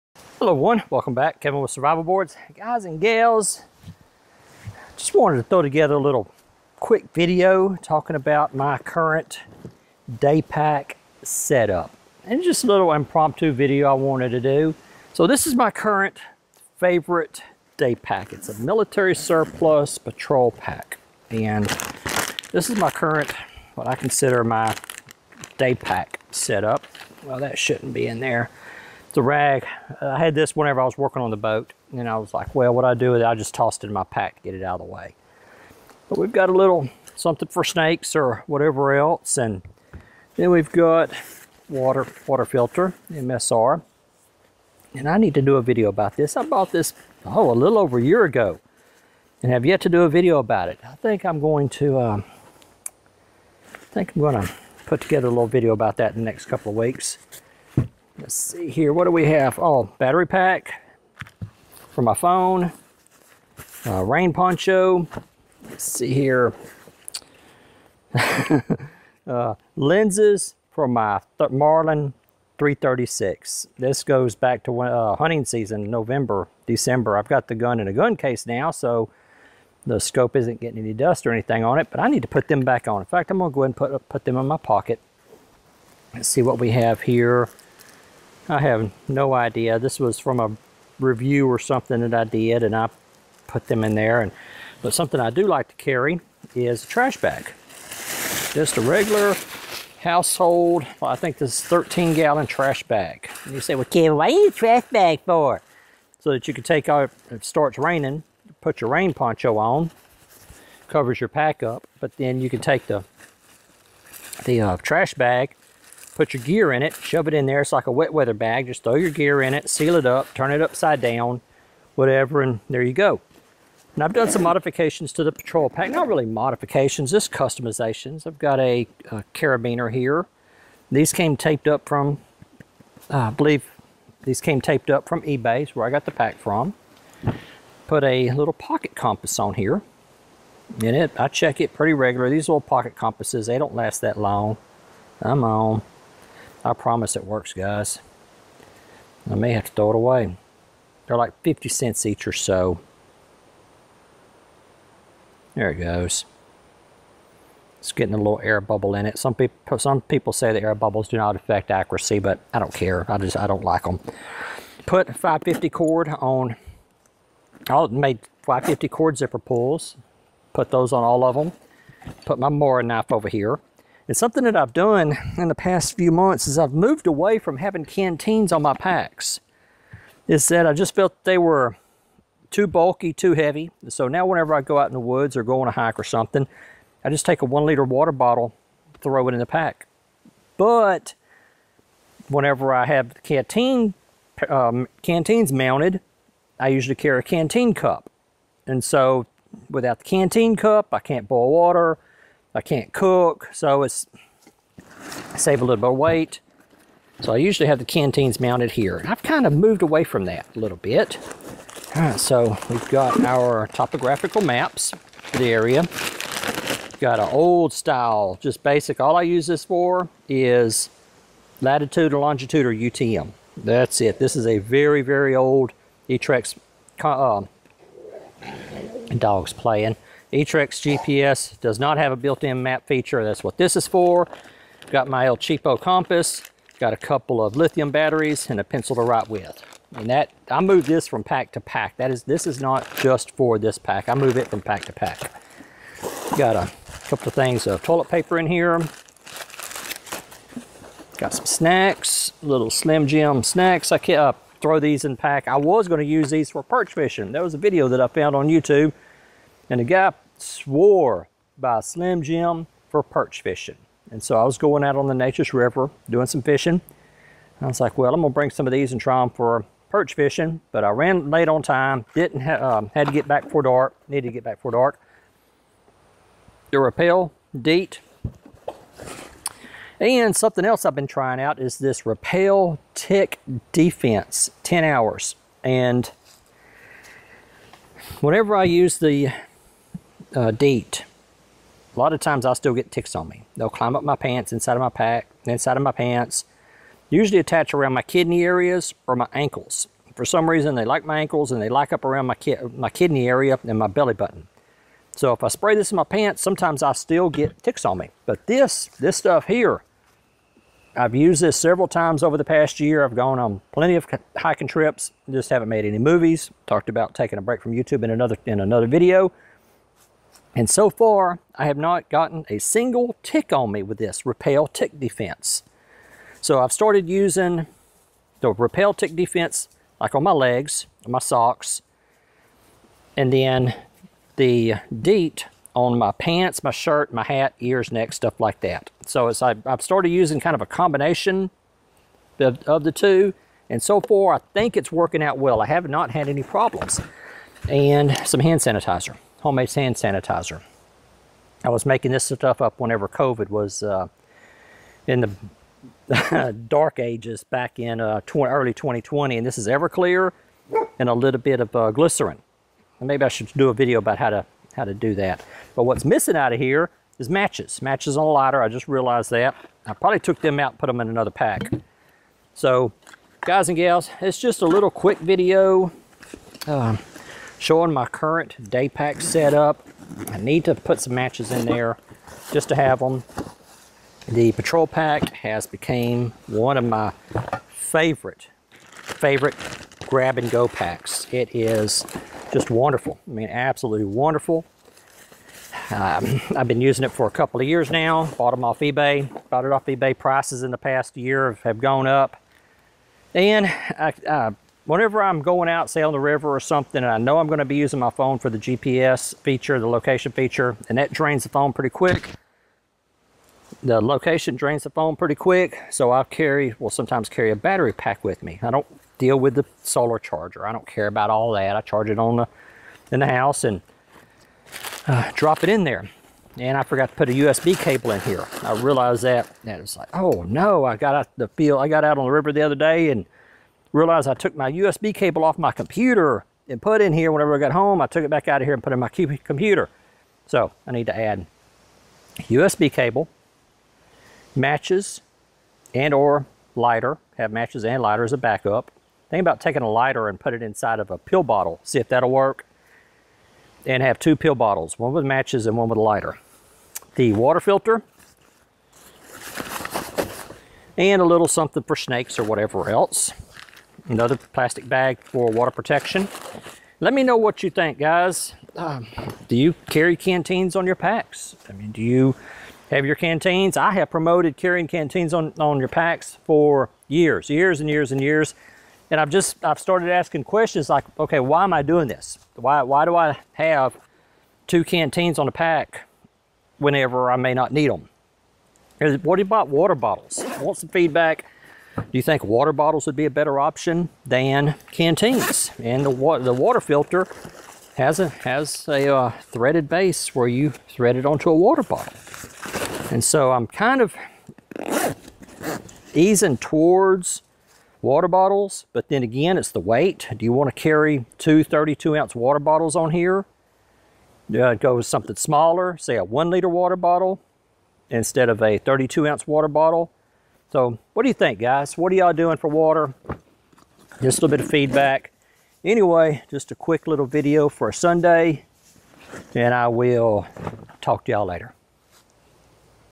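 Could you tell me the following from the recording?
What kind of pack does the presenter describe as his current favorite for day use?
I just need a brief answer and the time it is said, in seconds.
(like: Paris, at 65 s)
Military surplus patrol pack, at 18 s.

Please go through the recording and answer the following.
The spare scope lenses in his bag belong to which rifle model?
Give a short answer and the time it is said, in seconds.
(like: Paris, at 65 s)
Marlin 336, at 71 s.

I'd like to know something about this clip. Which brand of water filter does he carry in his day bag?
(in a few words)
MSR.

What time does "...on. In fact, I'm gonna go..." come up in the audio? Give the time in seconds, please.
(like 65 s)
82 s.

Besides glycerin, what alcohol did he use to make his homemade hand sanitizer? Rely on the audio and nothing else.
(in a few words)
Everclear.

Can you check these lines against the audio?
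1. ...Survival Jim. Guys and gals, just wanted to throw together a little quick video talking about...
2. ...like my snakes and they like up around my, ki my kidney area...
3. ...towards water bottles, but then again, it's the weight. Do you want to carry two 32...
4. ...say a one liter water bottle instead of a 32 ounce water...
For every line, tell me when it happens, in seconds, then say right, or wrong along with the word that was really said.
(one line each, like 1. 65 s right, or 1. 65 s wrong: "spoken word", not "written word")
1. 1 s wrong: "Boards", not "Jim"
2. 300 s wrong: "ankles", not "snakes"
3. 506 s right
4. 515 s right.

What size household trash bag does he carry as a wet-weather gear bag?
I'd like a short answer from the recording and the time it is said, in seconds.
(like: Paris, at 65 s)
13 gallon, at 101 s.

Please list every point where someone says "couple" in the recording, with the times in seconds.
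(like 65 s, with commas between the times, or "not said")
56 s, 236 s, 247 s, 397 s.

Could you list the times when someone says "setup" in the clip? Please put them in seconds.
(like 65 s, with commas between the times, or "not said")
11 s, 26 s, 379 s.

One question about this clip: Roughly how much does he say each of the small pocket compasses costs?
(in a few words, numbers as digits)
50 cents.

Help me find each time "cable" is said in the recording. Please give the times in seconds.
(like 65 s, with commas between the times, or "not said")
427 s, 435 s, 442 s.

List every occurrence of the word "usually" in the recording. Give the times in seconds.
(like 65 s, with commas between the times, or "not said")
196 s, 207 s, 297 s.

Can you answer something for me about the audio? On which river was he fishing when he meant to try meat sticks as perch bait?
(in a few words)
Neches River.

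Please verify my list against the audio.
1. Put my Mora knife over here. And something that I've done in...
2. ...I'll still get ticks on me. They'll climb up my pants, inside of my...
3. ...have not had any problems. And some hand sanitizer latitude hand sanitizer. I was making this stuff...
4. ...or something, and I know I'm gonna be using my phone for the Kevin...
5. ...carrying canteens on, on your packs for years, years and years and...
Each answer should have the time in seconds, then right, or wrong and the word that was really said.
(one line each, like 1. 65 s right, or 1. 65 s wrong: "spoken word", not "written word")
1. 172 s right
2. 292 s right
3. 345 s wrong: "homemade", not "latitude"
4. 406 s wrong: "GPS", not "Kevin"
5. 474 s right.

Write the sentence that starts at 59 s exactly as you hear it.
Oh, battery pack for my phone.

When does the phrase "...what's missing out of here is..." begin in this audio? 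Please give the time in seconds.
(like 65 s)
365 s.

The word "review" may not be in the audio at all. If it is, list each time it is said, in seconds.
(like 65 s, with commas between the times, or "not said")
90 s.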